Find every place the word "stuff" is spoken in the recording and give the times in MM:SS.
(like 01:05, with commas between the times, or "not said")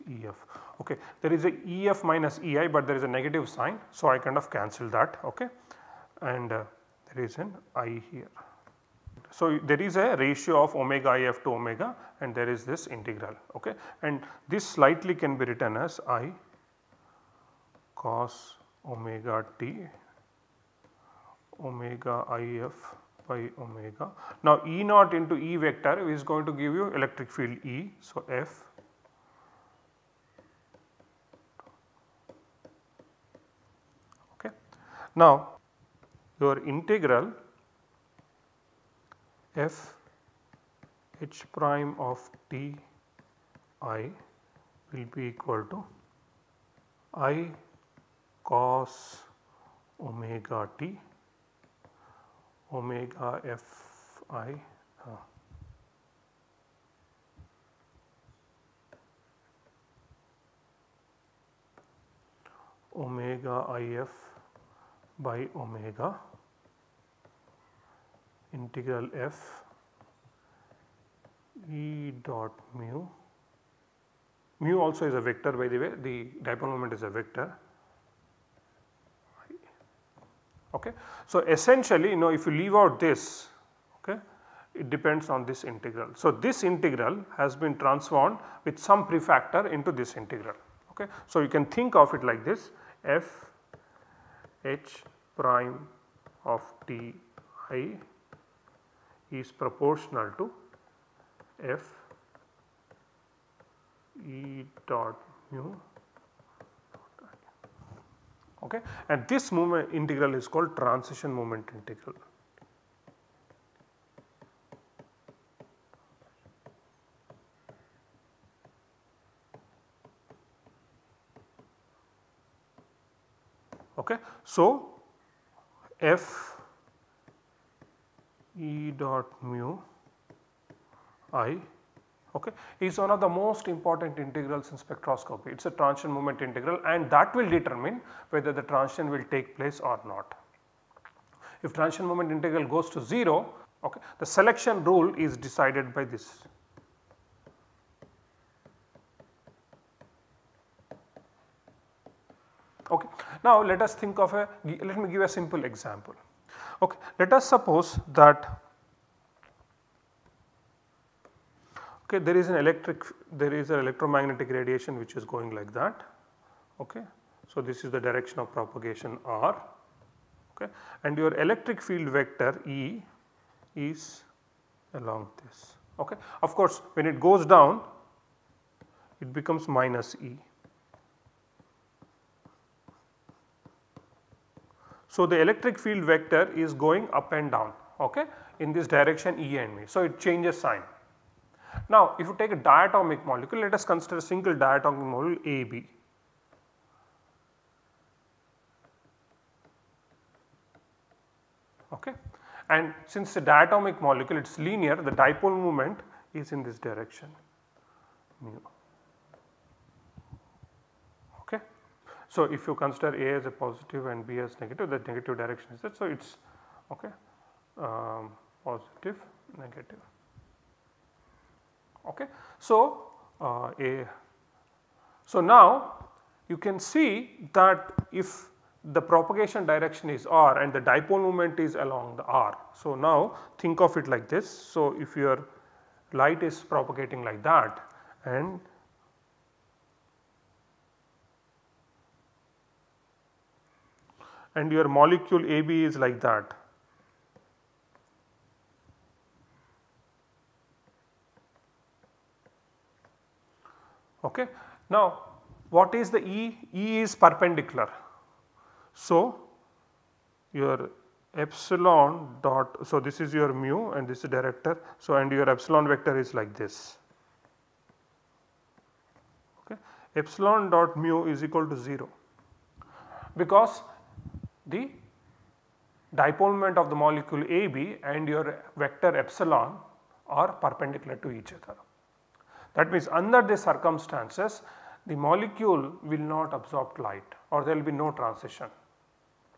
not said.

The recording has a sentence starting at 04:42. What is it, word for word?
That means under these circumstances the molecule will not absorb light or there will be no transition.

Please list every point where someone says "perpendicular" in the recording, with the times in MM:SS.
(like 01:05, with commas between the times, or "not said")
04:17, 04:40.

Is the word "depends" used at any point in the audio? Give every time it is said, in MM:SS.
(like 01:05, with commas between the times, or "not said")
01:24.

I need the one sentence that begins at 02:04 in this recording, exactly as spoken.
So, F E dot mu i okay, is one of the most important integrals in spectroscopy.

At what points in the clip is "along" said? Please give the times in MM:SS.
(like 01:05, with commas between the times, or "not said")
02:54, 03:51.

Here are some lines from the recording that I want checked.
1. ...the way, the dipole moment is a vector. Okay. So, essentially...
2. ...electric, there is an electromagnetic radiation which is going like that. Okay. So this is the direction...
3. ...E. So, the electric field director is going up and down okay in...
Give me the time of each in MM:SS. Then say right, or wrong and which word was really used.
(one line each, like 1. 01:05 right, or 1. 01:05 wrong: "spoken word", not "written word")
1. 01:15 right
2. 02:42 right
3. 03:00 wrong: "vector", not "director".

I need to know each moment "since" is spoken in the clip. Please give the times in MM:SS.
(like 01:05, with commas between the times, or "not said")
03:23.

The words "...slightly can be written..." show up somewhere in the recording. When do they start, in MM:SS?
00:14.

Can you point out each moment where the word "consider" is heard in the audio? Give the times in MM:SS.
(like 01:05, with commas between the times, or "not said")
03:13, 03:32.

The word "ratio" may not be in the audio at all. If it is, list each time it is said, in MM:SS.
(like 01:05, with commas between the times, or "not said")
00:10.